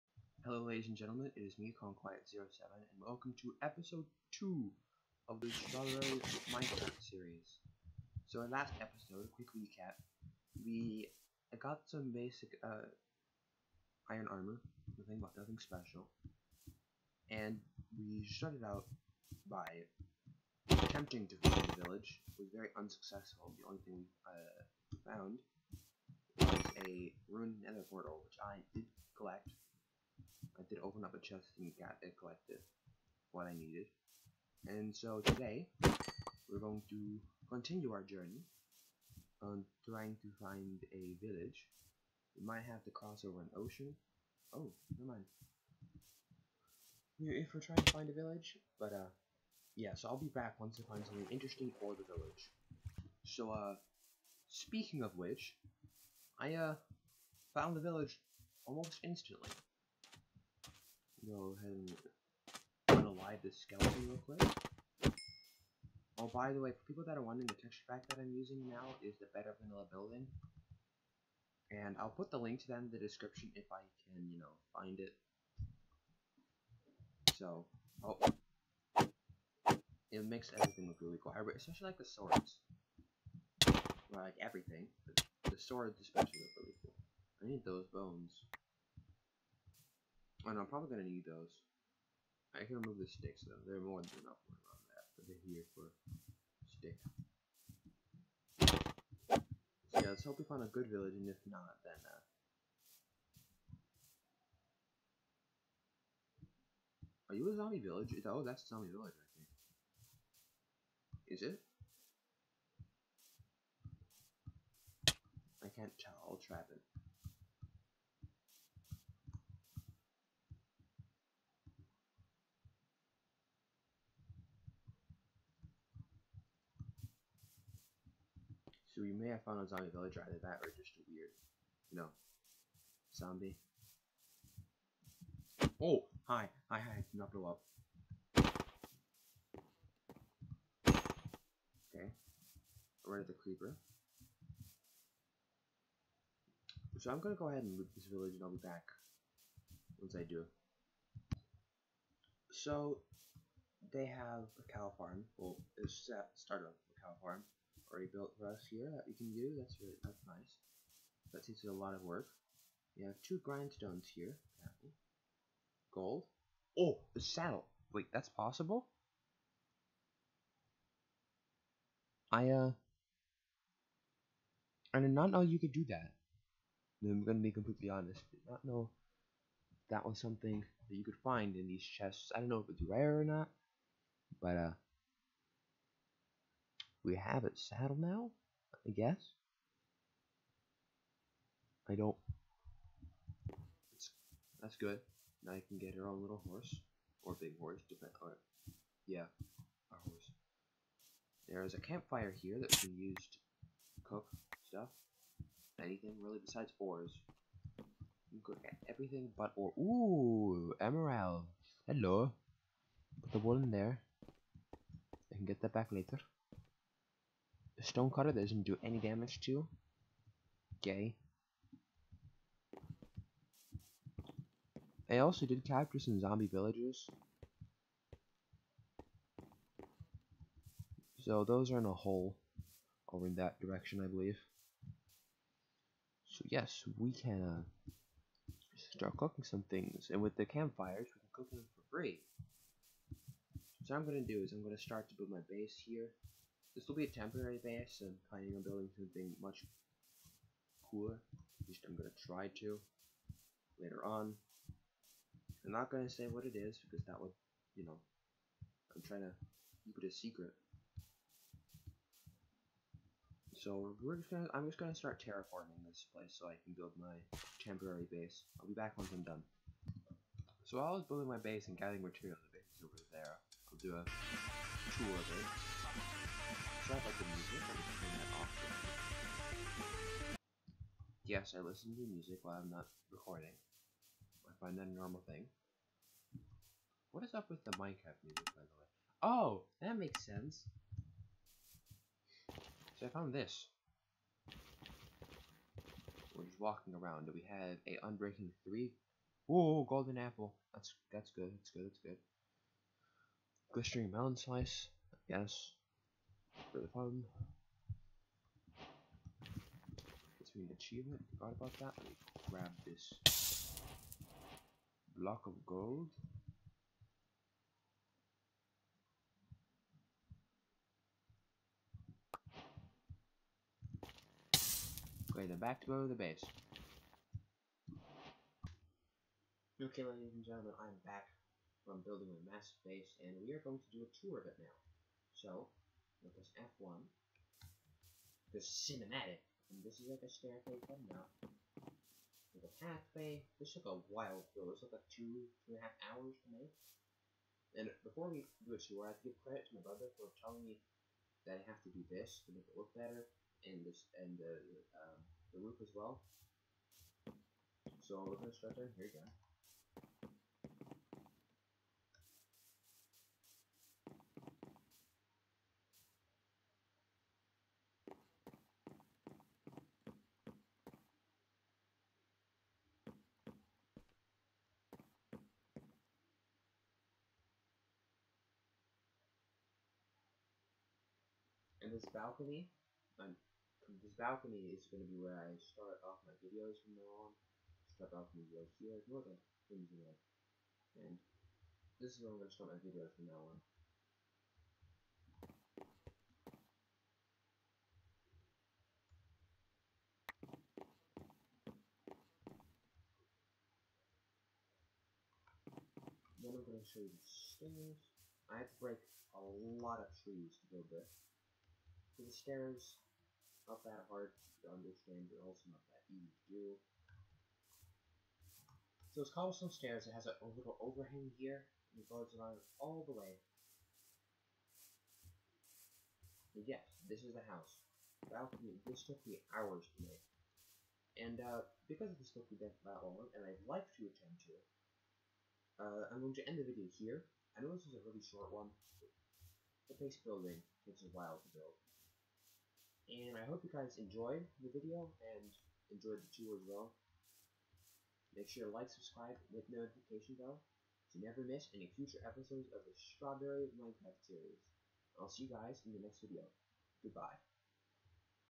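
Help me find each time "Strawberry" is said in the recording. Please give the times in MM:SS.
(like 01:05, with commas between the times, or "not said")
00:05, 07:32.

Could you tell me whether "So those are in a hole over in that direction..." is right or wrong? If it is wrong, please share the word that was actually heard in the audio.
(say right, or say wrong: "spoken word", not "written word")
right.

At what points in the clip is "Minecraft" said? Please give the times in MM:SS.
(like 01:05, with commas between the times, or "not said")
00:06, 04:47, 07:33.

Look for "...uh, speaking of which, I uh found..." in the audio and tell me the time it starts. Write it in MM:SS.
00:53.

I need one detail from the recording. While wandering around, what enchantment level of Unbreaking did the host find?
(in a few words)
3.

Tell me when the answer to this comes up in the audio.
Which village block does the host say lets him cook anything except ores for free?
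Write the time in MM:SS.
03:21.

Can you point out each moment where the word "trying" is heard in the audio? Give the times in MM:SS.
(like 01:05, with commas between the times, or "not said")
00:39, 00:47, 04:19.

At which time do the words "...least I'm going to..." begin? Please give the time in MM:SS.
04:11.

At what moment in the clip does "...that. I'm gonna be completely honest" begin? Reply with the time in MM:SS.
02:55.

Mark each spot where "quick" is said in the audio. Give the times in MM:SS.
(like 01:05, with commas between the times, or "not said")
00:09, 01:04.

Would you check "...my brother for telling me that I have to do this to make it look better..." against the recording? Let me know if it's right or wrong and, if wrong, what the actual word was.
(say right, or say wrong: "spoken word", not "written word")
right.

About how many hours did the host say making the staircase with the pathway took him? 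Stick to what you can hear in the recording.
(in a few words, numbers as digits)
2 and a half hours.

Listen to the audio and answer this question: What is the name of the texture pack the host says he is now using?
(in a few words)
Better Vanilla Building.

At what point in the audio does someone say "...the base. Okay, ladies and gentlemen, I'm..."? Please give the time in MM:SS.
05:26.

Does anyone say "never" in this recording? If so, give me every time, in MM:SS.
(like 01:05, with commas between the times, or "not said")
00:44, 07:31.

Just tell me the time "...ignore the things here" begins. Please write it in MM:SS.
06:29.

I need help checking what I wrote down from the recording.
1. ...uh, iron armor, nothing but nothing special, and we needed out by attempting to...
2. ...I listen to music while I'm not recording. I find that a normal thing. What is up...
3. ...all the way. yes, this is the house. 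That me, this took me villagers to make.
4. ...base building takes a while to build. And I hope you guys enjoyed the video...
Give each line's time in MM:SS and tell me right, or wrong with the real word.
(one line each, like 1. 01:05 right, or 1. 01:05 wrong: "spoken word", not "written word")
1. 00:12 wrong: "started", not "needed"
2. 04:41 right
3. 07:02 wrong: "hours", not "villagers"
4. 07:19 right.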